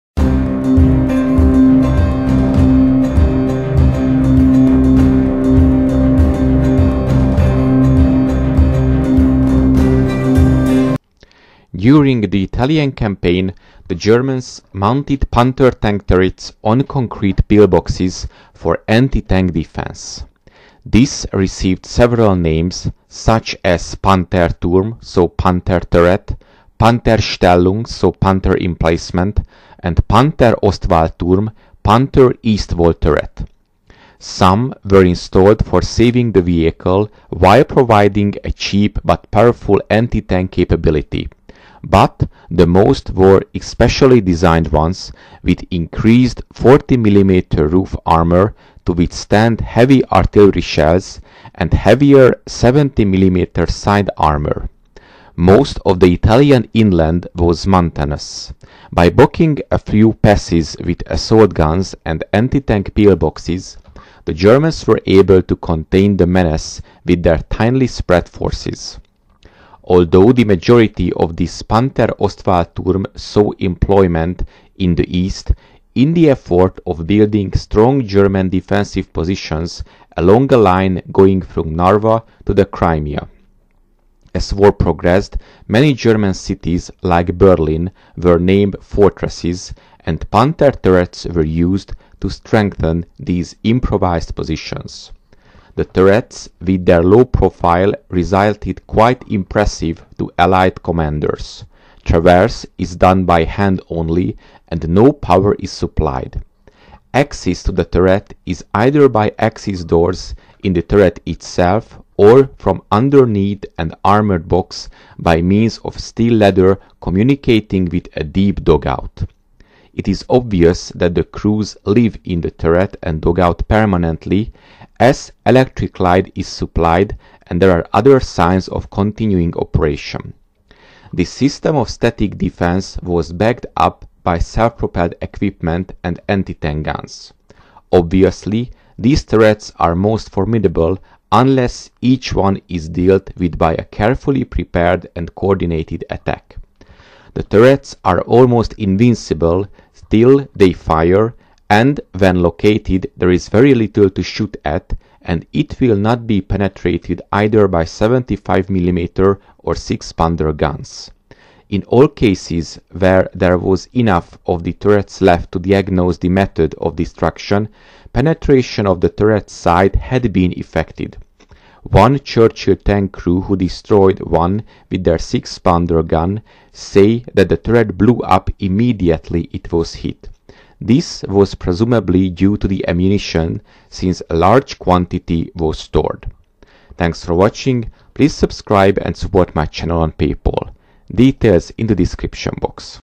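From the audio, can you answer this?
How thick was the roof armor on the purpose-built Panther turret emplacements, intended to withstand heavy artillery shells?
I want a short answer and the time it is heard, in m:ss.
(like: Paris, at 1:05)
40 mm, at 0:46.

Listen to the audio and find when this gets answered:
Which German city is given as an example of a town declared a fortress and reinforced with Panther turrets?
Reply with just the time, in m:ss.
1:27.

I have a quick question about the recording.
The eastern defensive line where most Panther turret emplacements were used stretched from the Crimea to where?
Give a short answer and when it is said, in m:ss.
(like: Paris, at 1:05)
Narva, at 1:21.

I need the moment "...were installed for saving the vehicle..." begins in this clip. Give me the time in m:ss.
0:34.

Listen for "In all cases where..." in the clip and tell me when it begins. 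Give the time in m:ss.
2:41.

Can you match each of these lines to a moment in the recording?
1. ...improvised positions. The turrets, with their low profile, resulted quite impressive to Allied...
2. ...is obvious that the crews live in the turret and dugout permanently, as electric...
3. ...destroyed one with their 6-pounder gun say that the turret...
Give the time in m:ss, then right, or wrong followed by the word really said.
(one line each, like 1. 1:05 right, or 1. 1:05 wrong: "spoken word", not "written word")
1. 1:33 right
2. 2:00 right
3. 2:53 right.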